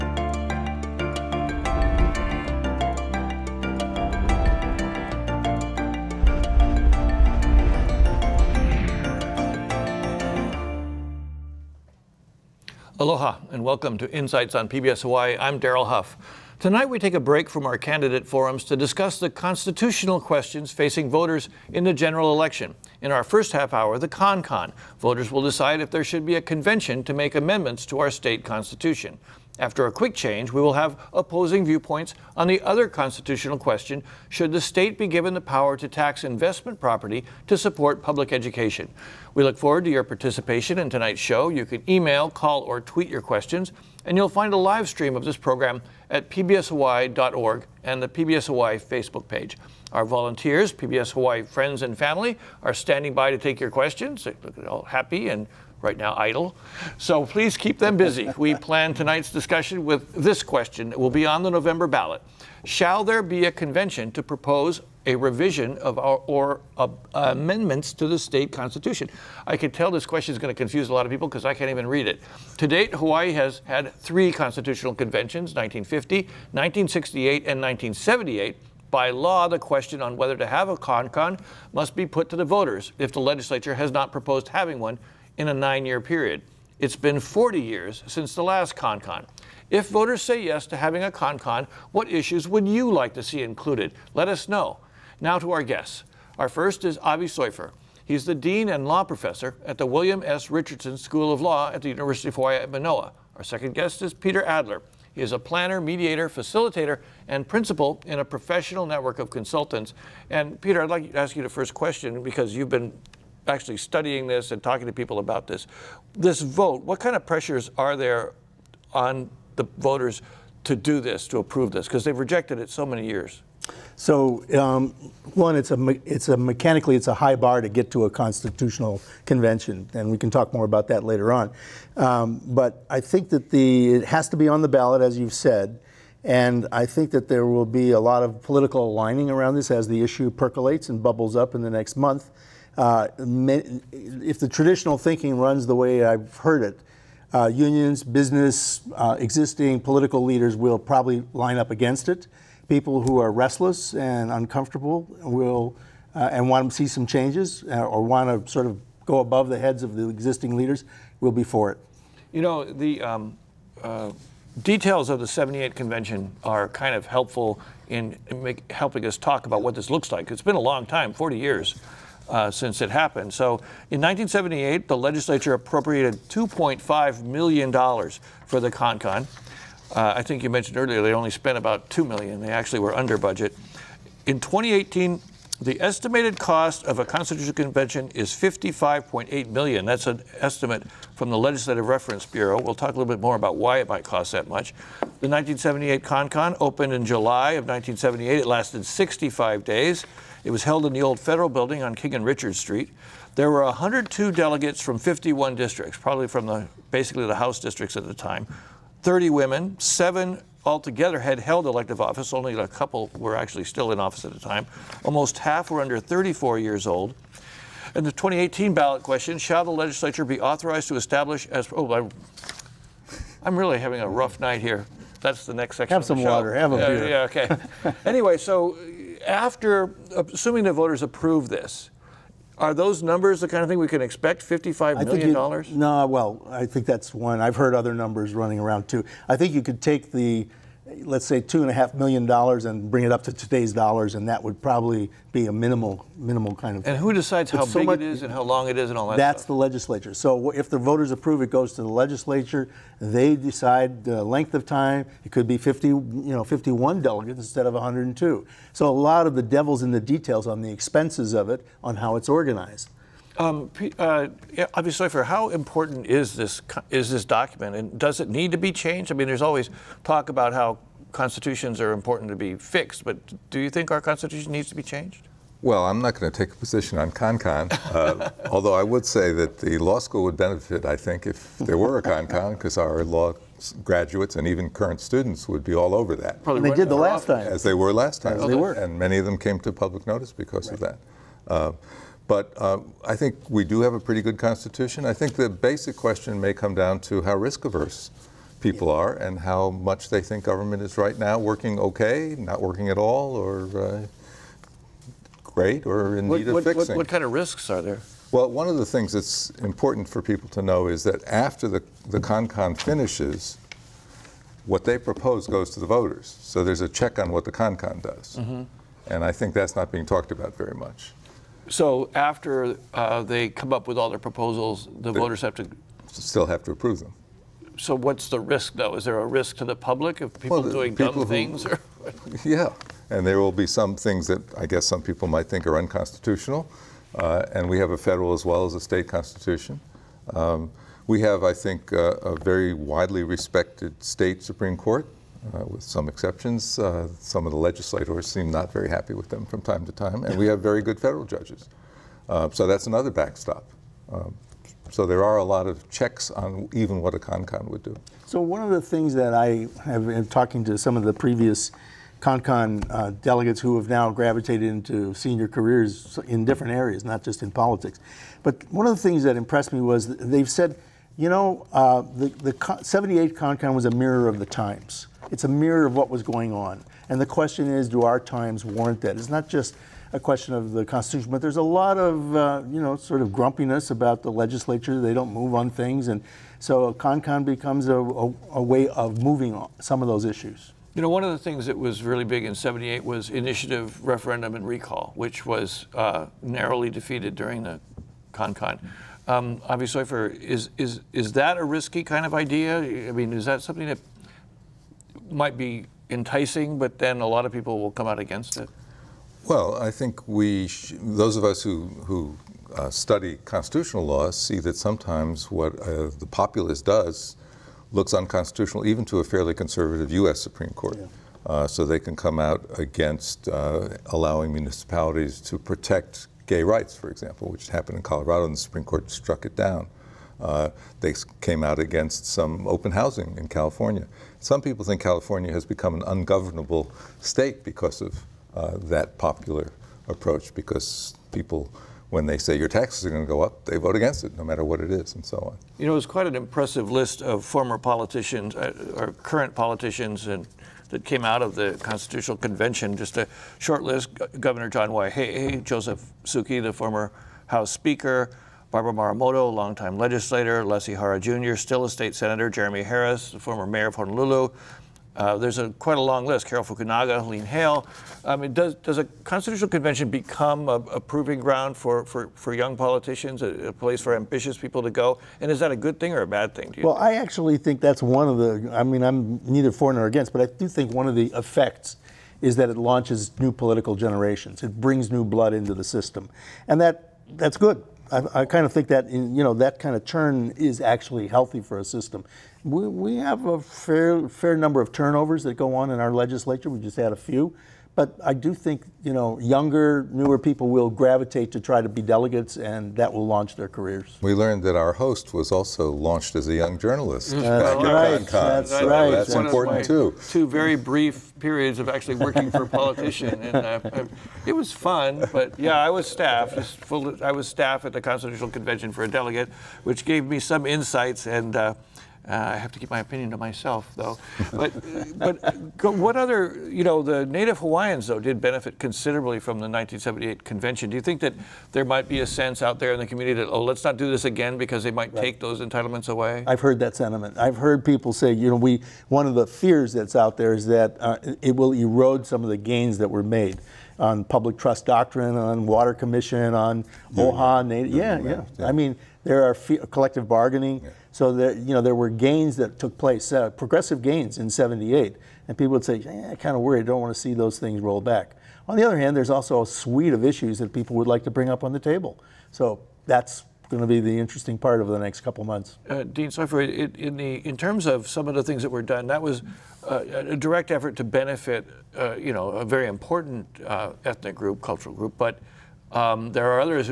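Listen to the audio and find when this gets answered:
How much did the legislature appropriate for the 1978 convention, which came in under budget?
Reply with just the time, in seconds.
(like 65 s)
176 s.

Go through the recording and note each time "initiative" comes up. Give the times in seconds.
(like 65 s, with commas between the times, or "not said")
393 s.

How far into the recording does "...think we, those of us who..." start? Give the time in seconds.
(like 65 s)
409 s.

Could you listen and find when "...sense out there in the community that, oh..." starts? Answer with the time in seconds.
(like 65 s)
532 s.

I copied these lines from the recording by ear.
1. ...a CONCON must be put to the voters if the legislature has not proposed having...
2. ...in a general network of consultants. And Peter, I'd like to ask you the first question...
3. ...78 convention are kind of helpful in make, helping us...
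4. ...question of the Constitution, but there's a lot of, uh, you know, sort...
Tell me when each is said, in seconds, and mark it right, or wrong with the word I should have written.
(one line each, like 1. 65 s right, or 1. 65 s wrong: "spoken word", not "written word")
1. 80 s right
2. 108 s wrong: "professional", not "general"
3. 165 s right
4. 380 s right.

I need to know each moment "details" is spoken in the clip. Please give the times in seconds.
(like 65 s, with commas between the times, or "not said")
164 s, 260 s.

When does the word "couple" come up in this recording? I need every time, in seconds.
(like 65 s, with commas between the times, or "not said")
212 s, 565 s.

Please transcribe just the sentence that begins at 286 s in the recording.
Probably they did the last time.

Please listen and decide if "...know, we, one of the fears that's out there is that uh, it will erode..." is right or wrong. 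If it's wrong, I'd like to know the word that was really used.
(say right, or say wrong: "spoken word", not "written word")
right.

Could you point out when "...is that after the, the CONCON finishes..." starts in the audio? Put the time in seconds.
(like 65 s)
310 s.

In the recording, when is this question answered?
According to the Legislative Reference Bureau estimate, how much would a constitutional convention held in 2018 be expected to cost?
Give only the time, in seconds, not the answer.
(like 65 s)
188 s.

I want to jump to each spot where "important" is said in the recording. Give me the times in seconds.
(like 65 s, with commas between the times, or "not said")
265 s, 271 s, 309 s, 509 s, 572 s.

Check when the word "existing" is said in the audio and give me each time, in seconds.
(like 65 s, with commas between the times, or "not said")
149 s, 160 s.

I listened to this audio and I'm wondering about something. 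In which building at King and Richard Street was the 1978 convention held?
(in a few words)
the old federal building.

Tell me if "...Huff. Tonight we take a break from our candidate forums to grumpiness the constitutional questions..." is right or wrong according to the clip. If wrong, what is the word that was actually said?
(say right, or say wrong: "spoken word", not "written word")
wrong: "discuss", not "grumpiness".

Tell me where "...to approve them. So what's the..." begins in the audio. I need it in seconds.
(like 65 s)
326 s.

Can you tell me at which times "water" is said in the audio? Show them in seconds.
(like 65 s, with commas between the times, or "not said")
226 s, 545 s.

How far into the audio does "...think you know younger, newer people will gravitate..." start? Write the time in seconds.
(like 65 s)
498 s.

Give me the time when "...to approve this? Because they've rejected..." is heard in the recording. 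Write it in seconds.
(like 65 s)
121 s.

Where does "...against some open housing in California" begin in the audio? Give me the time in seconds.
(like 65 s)
431 s.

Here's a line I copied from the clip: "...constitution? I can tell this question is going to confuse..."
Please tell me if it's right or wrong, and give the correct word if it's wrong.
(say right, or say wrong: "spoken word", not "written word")
right.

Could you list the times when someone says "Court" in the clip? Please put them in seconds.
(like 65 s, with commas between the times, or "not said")
344 s, 420 s, 428 s.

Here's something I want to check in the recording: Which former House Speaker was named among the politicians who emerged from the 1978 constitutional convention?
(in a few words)
Joseph Souki.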